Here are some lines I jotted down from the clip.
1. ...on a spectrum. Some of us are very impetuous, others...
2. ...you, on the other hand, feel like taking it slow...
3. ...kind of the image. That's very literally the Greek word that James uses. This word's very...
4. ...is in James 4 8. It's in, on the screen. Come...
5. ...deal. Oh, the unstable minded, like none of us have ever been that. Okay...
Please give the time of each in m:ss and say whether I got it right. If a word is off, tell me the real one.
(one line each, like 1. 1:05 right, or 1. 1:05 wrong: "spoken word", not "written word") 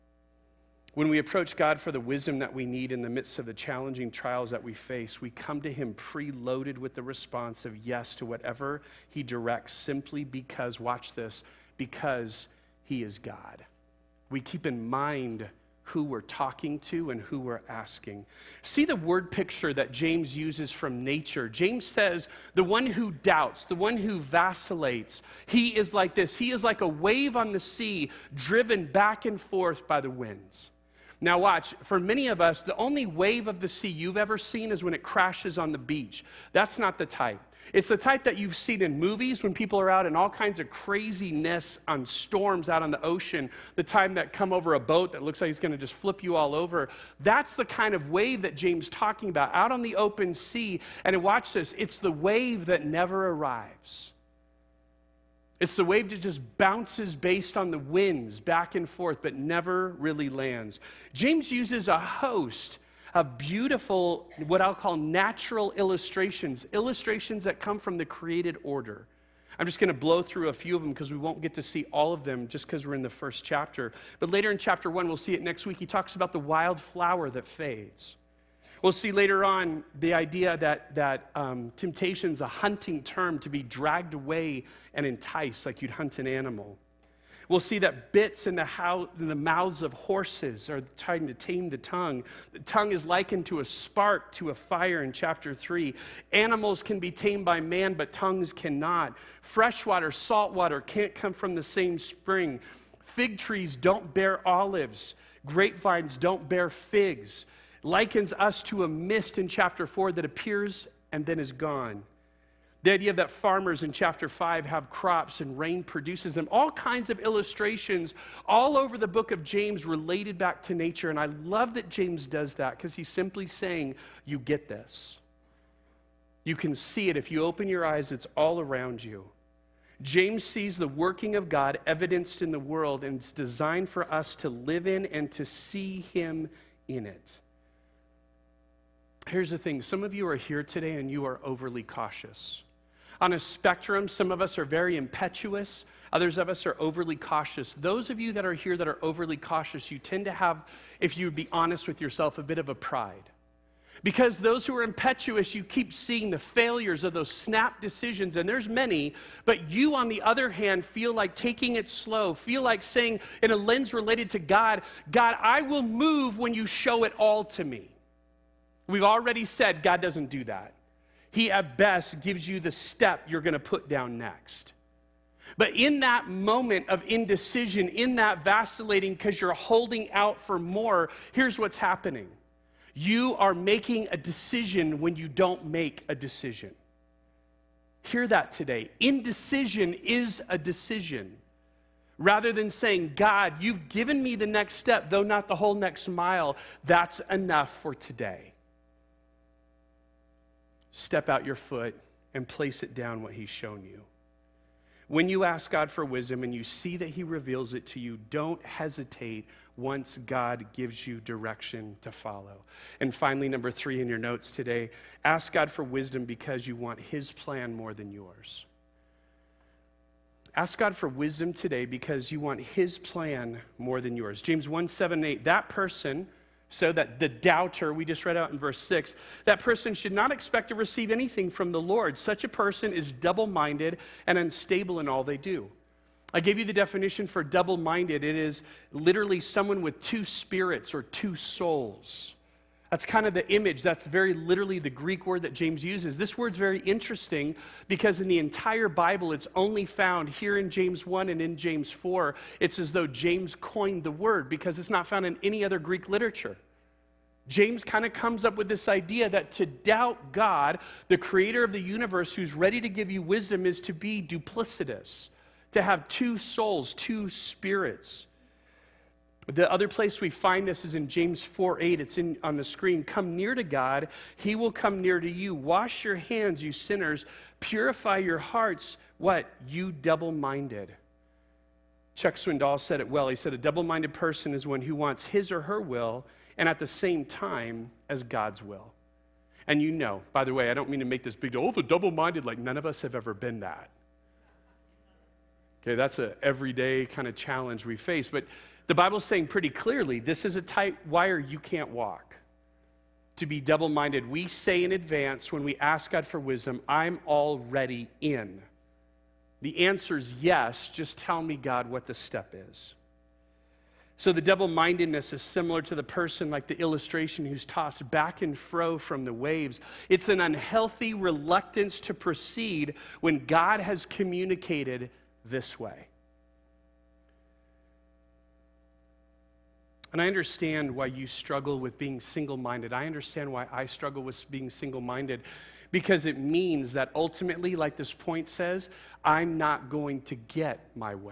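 1. 2:23 right
2. 2:39 right
3. 4:03 right
4. 4:30 right
5. 4:51 wrong: "double", not "unstable".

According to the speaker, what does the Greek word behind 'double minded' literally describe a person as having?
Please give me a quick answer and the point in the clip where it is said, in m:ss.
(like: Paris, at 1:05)
Two spirits or two souls, at 4:00.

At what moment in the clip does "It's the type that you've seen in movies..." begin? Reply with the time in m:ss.
0:37.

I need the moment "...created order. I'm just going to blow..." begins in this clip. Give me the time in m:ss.
1:08.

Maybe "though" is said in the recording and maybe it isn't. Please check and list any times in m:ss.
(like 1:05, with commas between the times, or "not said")
3:15, 4:12.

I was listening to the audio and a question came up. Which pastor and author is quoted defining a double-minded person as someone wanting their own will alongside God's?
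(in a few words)
Chuck Swindoll.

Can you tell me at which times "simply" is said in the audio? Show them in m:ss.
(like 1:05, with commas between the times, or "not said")
0:09, 2:03.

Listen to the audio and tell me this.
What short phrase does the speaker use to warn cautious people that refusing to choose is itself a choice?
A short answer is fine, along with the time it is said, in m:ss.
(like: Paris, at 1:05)
Indecision is a decision, at 3:09.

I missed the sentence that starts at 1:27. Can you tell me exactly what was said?
We'll see that bits in the, how, in the mouths of horses are trying to tame the tongue.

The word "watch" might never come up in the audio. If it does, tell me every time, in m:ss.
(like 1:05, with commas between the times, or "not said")
0:10, 0:31, 0:51.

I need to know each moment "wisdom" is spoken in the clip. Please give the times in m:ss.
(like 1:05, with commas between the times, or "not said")
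0:02, 3:26, 3:35, 3:41, 4:23, 5:06.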